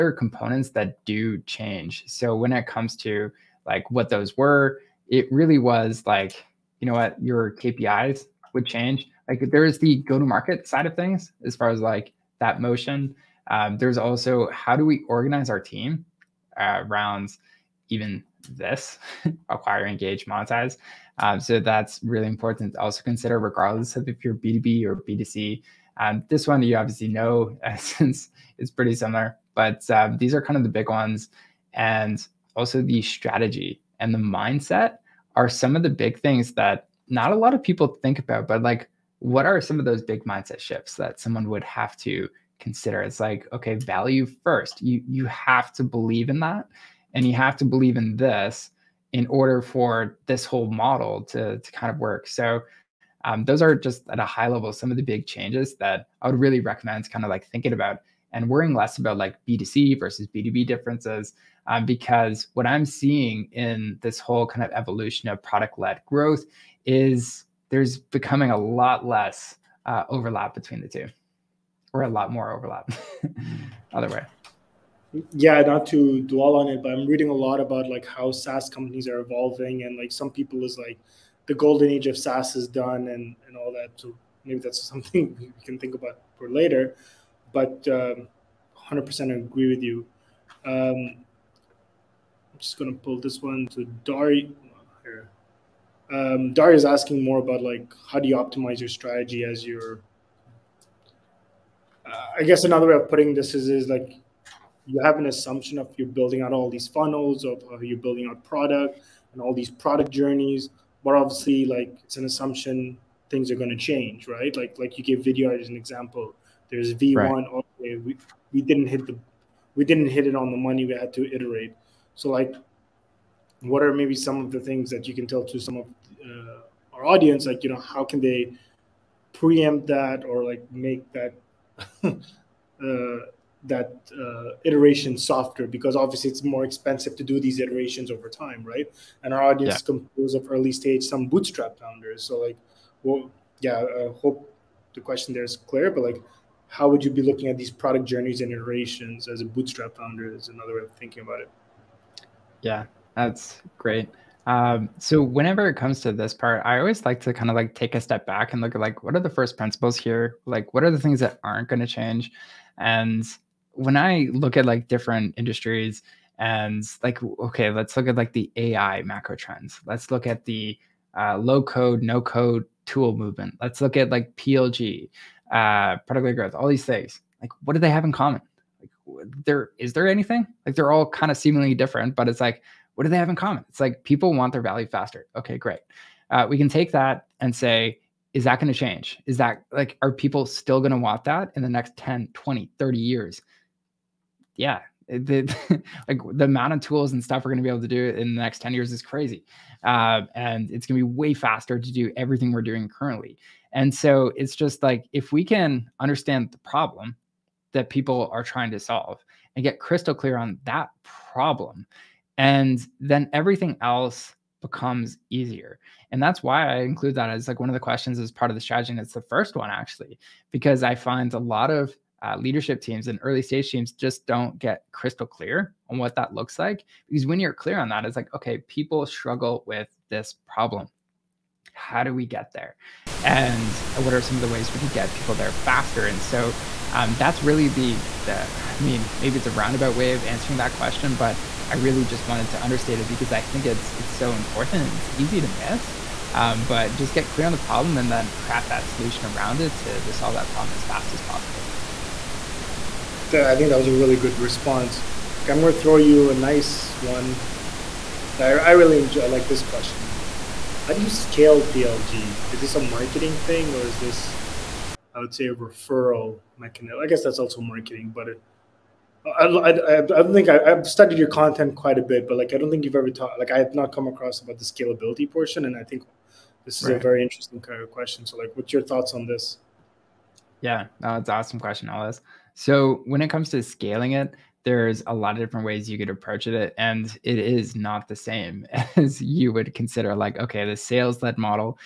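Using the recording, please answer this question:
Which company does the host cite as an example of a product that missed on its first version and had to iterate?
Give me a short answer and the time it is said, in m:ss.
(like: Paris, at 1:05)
Vidyard, at 1:55.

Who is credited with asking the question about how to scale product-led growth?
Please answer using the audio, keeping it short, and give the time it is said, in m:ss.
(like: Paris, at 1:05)
Alice, at 4:41.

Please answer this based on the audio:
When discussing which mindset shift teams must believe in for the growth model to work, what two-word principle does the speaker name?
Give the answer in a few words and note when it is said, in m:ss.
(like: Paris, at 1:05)
Value first, at 0:43.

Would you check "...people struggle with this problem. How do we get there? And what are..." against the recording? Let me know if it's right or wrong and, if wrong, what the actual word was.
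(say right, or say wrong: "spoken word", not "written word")
right.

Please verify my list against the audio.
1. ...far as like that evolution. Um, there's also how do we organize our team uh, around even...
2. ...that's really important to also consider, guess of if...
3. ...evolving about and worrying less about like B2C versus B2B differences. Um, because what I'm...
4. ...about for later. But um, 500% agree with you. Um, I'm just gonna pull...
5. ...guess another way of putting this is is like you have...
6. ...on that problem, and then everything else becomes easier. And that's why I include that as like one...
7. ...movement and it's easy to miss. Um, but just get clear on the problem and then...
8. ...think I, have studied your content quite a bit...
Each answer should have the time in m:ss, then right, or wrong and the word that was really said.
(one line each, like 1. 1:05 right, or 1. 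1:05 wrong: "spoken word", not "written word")
1. 0:11 wrong: "motion", not "evolution"
2. 0:21 wrong: "regardless", not "guess"
3. 0:57 wrong: "thinking", not "evolving"
4. 1:25 wrong: "100", not "500"
5. 1:42 right
6. 3:30 right
7. 4:04 wrong: "important", not "movement"
8. 4:30 right.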